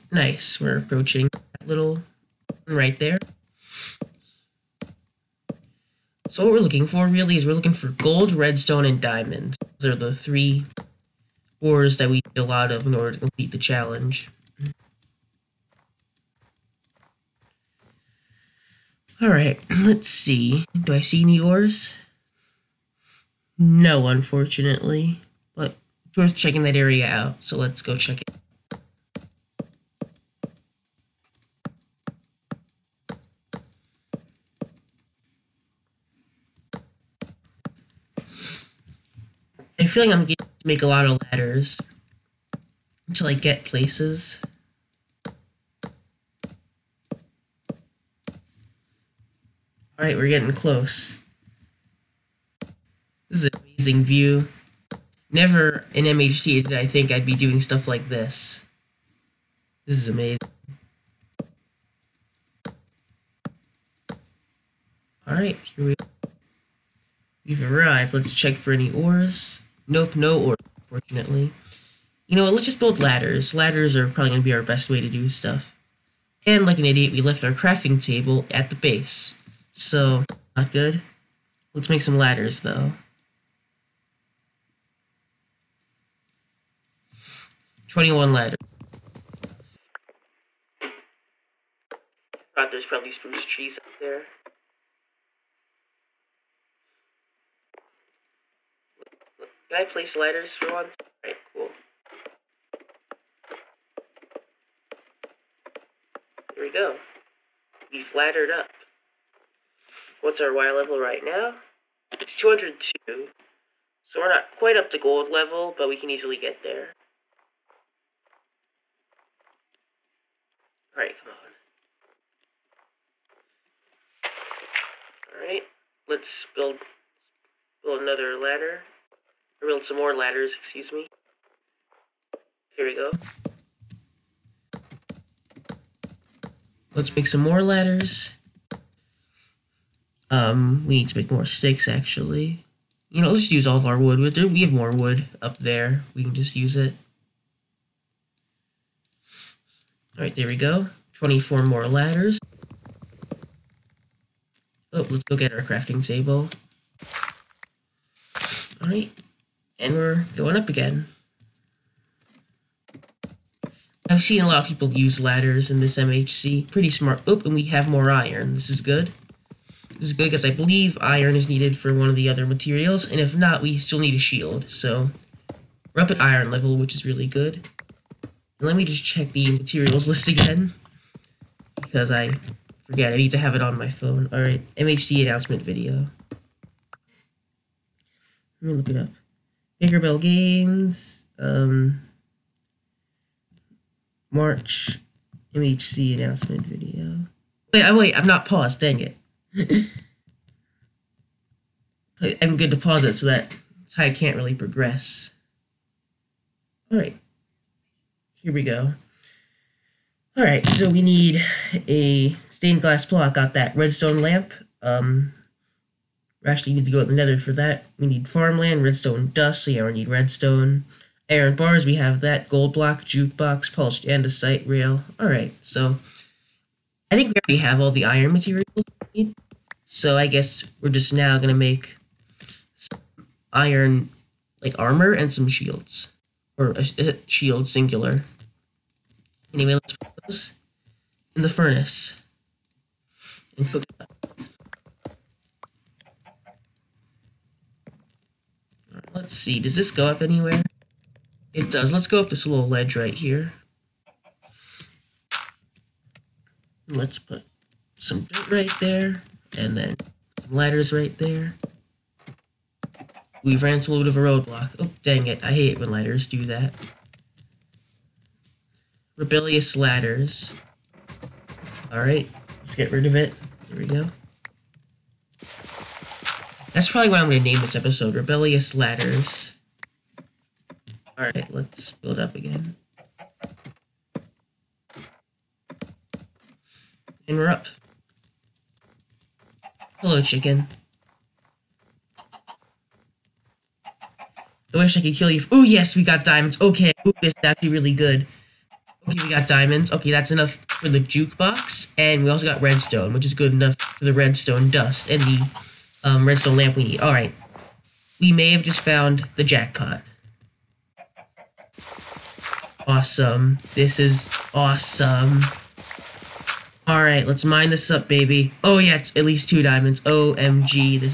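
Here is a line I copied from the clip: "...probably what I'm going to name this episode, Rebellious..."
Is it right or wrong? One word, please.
right.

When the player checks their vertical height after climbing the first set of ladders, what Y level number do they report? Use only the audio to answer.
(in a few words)
202.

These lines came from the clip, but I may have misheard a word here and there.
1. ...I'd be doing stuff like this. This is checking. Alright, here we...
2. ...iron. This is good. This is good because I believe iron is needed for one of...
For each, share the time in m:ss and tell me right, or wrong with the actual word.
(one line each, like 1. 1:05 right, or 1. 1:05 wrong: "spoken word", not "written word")
1. 0:57 wrong: "amazing", not "checking"
2. 2:48 right.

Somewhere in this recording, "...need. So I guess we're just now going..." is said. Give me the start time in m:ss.
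3:49.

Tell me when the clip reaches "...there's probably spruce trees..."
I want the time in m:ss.
1:32.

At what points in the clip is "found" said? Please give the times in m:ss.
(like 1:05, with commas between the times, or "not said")
5:08.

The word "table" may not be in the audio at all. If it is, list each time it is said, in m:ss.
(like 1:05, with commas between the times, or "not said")
1:18, 2:36.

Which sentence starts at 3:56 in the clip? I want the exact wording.
Or a, uh, a uh, shield, singular.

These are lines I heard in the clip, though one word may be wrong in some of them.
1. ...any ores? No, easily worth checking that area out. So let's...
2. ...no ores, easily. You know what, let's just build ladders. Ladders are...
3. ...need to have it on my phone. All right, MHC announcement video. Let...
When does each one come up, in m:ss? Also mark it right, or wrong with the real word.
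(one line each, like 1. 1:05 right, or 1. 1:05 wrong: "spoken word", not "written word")
1. 0:21 wrong: "unfortunately", not "easily"
2. 1:10 wrong: "fortunately", not "easily"
3. 3:03 right.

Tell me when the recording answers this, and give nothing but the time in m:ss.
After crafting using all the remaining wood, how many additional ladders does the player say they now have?
2:31.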